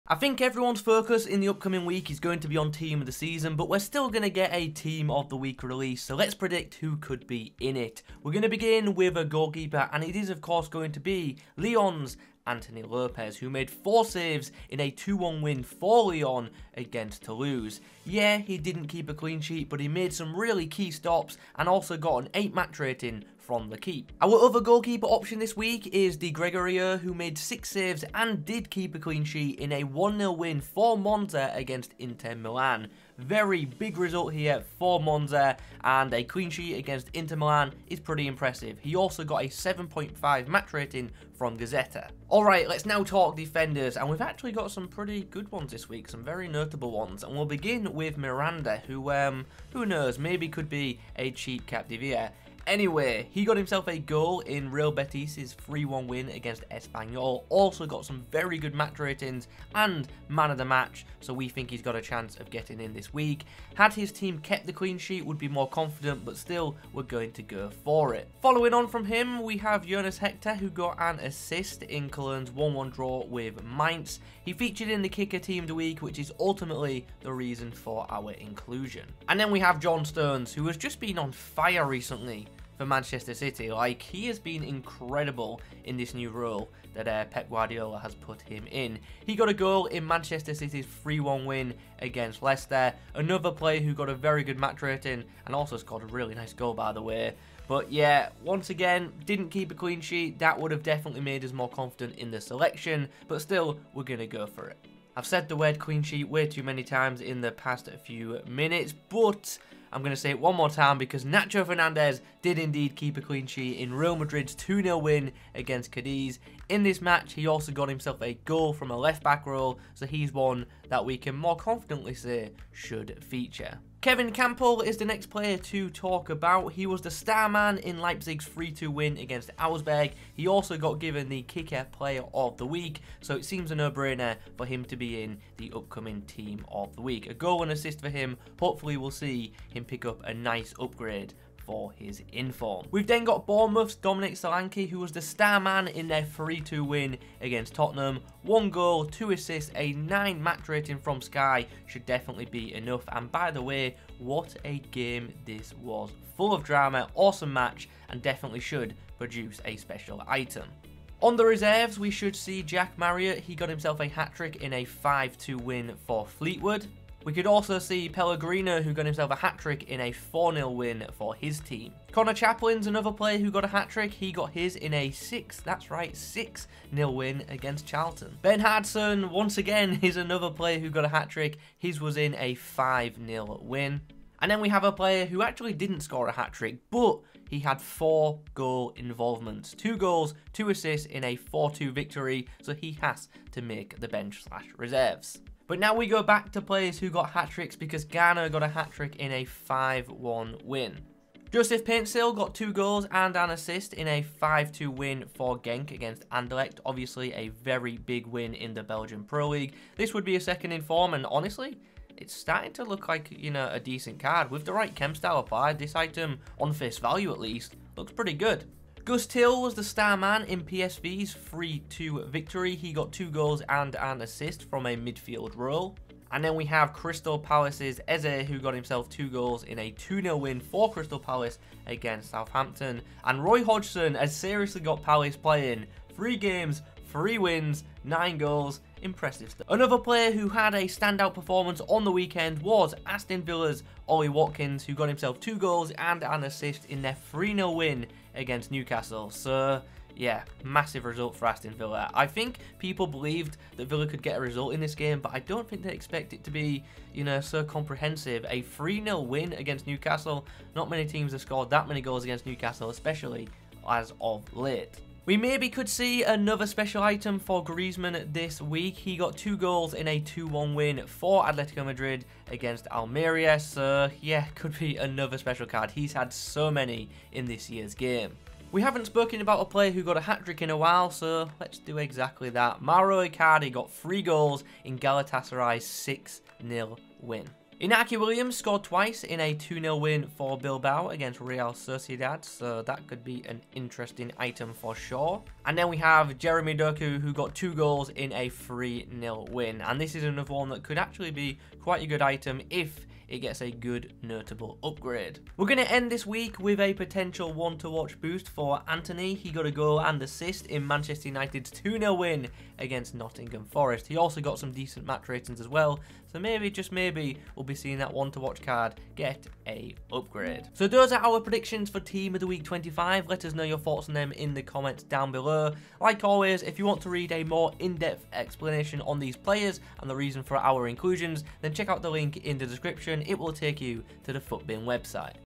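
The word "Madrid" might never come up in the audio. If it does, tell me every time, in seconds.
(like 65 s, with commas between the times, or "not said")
114 s, 271 s.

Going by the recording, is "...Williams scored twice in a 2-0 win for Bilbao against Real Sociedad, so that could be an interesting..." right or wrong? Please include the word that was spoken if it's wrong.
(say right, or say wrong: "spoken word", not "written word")
right.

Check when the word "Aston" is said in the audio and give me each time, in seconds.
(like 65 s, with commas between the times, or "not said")
243 s, 251 s.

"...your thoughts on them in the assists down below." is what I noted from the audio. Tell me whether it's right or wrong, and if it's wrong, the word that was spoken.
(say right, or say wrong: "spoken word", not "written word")
wrong: "comments", not "assists".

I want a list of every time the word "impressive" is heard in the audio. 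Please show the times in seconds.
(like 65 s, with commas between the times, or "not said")
38 s, 239 s.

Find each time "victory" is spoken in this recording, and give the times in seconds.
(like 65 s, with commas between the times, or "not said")
191 s, 222 s.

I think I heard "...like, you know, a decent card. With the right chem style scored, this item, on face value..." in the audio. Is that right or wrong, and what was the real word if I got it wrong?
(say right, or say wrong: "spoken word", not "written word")
wrong: "applied", not "scored".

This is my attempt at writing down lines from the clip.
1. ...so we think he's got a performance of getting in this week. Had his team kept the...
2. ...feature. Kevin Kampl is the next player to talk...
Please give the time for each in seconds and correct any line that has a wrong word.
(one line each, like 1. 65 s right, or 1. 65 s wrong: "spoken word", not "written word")
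1. 61 s wrong: "chance", not "performance"
2. 123 s right.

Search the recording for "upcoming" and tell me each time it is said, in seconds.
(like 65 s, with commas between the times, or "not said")
1 s, 135 s.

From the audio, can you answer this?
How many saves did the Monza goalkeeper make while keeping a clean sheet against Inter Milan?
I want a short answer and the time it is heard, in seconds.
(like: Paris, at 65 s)
6, at 27 s.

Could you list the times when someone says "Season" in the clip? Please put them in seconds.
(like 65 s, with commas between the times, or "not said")
3 s.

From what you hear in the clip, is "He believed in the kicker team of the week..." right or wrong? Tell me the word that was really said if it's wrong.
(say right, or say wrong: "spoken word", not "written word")
wrong: "featured", not "believed".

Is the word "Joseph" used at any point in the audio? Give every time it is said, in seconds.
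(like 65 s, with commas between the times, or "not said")
201 s.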